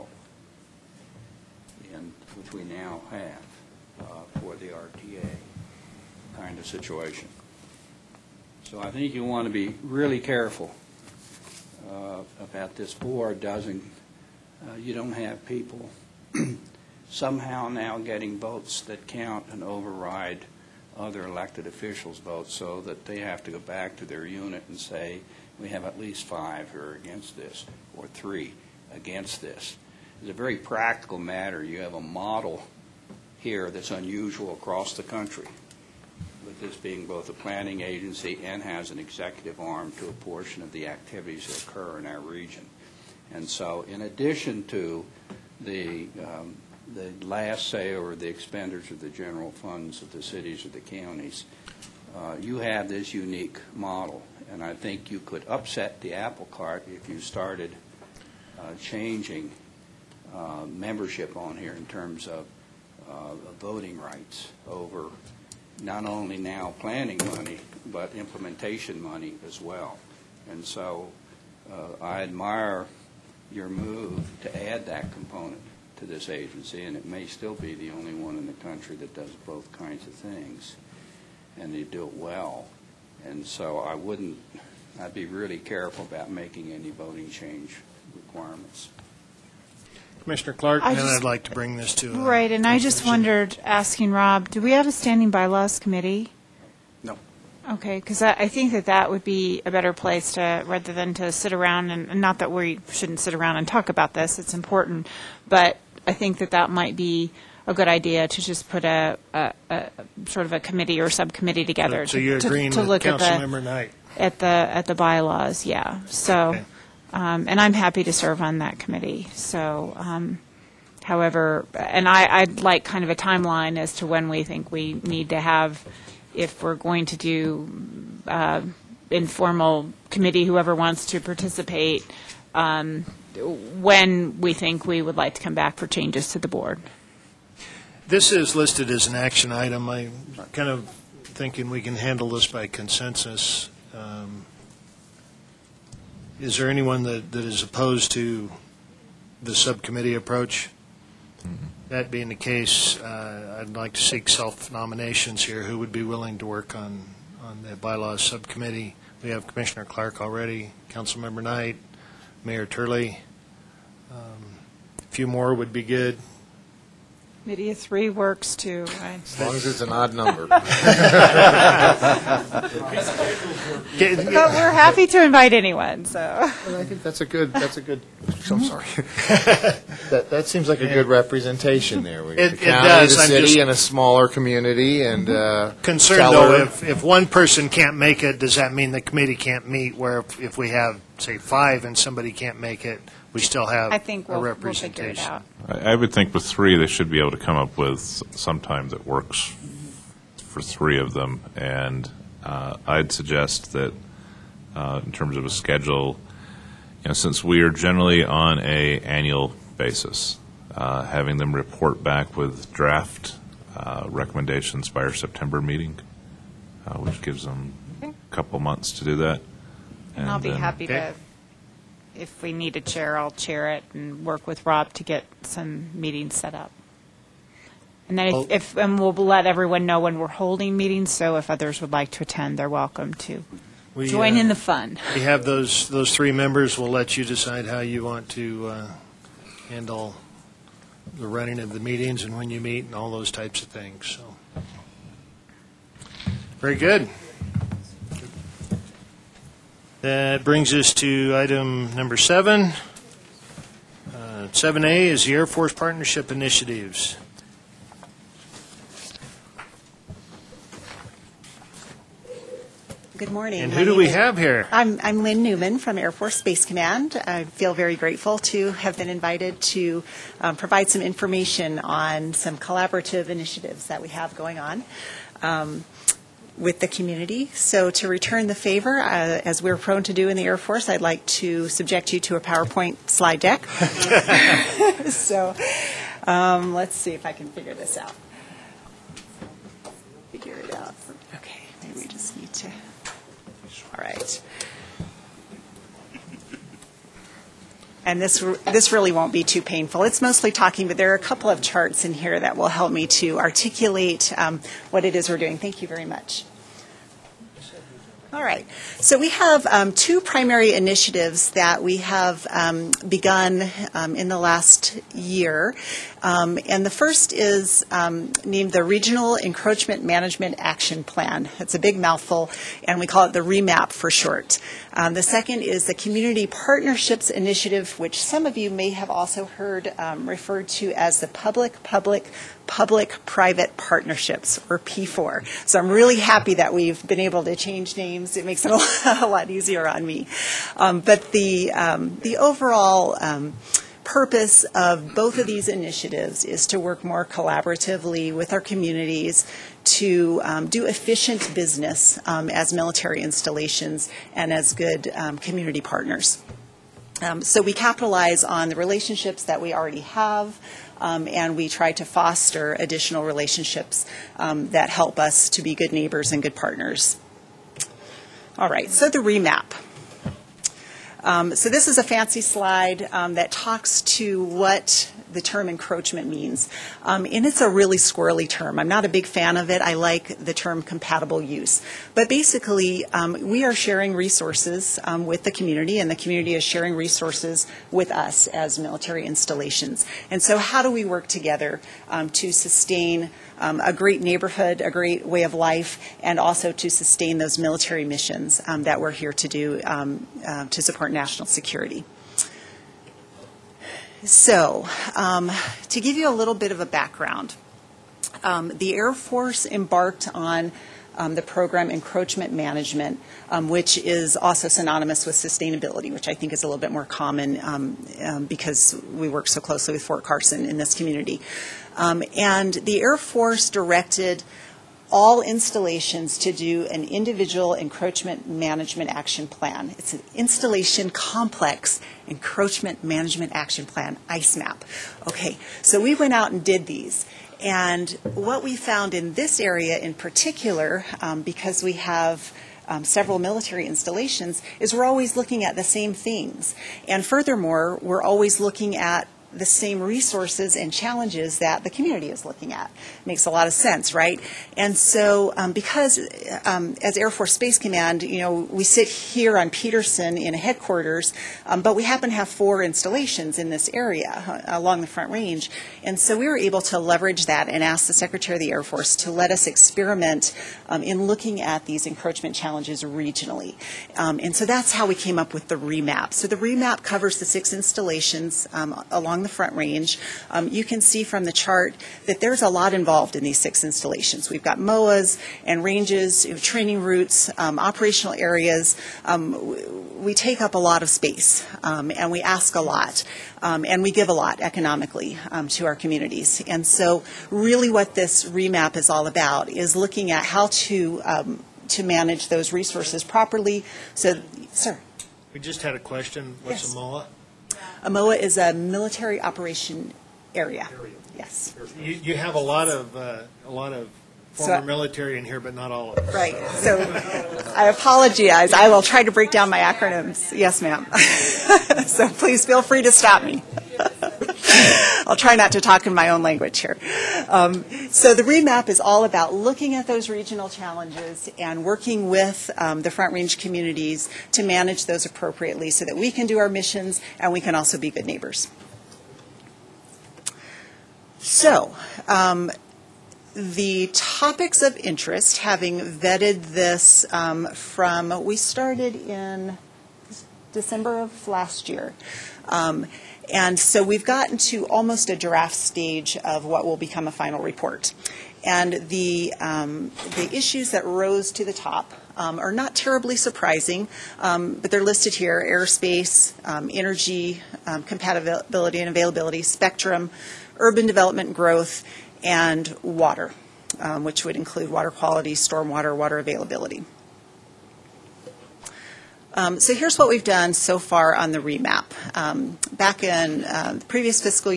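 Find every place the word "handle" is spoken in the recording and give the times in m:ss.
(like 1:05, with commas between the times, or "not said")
2:21, 3:59.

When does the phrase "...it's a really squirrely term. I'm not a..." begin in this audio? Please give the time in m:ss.
6:17.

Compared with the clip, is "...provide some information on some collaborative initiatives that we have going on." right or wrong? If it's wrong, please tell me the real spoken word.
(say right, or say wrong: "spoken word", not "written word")
right.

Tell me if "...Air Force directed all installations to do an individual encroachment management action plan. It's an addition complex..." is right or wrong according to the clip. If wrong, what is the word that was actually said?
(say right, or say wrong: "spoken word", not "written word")
wrong: "installation", not "addition".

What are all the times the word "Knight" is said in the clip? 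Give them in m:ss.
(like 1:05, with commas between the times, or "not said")
1:53, 2:41.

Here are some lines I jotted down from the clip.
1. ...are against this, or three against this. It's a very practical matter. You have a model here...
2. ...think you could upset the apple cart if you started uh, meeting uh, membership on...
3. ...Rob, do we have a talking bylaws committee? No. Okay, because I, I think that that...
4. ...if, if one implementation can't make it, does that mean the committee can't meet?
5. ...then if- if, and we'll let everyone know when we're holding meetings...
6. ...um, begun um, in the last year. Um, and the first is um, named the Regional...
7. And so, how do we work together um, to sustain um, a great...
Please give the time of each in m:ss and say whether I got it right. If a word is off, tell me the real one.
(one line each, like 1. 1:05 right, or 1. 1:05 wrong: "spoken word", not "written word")
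1. 0:26 right
2. 0:54 wrong: "changing", not "meeting"
3. 1:34 wrong: "standing", not "talking"
4. 3:06 wrong: "person", not "implementation"
5. 3:48 right
6. 5:12 right
7. 6:30 right.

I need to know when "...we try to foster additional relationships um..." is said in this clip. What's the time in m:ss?
6:01.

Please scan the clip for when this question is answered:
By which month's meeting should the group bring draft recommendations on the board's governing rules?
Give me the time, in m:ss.
3:35.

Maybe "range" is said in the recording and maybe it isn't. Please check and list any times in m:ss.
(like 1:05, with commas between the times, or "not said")
7:45, 7:59, 8:05, 8:53.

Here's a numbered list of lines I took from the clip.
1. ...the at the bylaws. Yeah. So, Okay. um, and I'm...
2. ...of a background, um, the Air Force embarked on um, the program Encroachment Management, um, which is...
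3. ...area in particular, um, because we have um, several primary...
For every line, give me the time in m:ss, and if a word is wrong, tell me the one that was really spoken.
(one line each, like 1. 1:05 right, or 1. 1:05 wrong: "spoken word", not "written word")
1. 1:54 right
2. 6:46 right
3. 7:19 wrong: "military", not "primary".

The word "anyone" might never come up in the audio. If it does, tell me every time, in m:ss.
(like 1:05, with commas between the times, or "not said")
2:26, 2:55.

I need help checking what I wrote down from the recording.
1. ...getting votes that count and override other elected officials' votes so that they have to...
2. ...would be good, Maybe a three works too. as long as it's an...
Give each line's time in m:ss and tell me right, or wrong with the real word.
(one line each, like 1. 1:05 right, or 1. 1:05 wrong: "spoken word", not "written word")
1. 0:17 right
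2. 2:45 right.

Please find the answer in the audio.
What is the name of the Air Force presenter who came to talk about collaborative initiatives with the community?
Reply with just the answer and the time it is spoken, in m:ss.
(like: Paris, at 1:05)
Lynn Newman, at 4:25.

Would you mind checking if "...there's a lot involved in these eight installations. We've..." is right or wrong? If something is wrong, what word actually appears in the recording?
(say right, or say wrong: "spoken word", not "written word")
wrong: "six", not "eight".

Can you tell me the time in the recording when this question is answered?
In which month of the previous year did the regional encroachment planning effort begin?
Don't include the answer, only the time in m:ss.
9:10.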